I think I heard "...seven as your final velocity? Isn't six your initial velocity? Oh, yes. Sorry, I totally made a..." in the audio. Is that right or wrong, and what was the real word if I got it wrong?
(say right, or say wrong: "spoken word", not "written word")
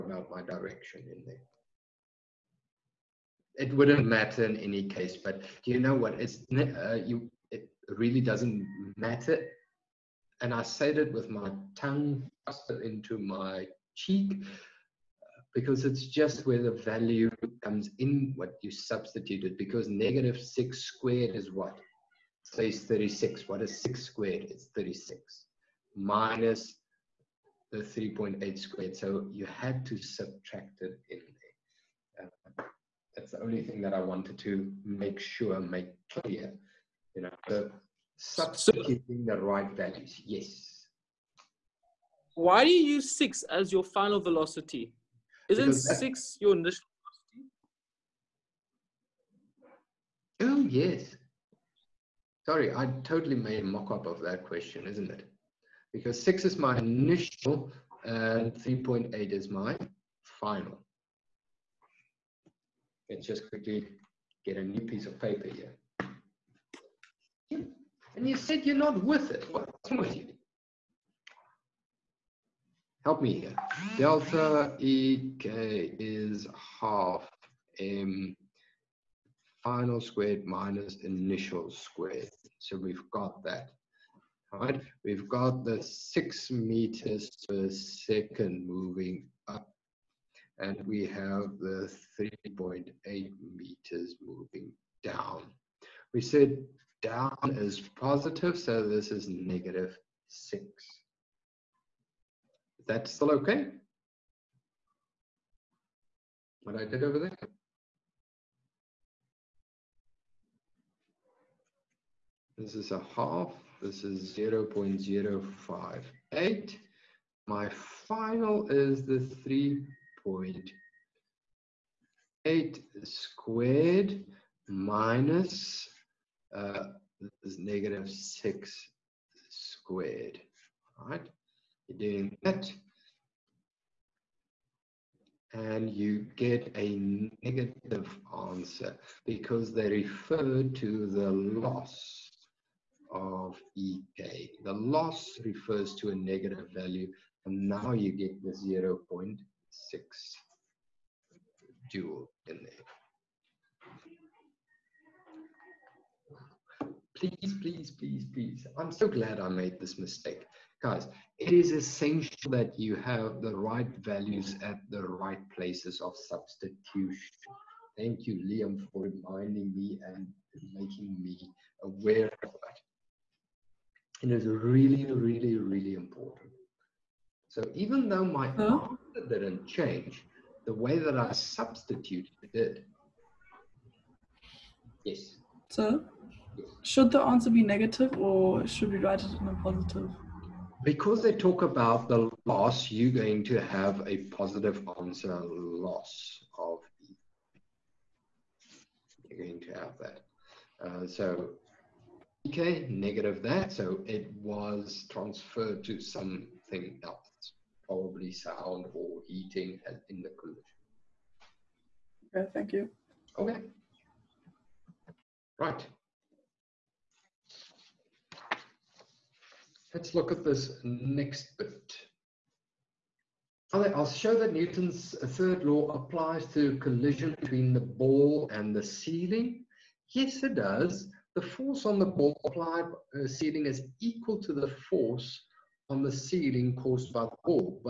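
wrong: "six", not "seven".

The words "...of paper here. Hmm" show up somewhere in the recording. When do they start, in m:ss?
1:05.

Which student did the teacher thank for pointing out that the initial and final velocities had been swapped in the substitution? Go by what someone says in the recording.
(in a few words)
Liam.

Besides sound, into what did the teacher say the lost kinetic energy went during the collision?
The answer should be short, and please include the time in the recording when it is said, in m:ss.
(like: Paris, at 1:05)
heating, at 3:29.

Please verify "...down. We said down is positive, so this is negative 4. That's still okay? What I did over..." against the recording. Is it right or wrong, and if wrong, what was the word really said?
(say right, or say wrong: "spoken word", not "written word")
wrong: "6", not "4".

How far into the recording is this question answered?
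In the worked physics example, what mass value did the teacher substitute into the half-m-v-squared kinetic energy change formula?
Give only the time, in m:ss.
1:54.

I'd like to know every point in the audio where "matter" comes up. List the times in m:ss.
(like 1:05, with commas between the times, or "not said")
0:04, 0:08.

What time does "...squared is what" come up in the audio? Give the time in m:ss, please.
0:20.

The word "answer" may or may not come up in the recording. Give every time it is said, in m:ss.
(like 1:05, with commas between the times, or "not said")
2:18, 2:59, 3:07, 3:15.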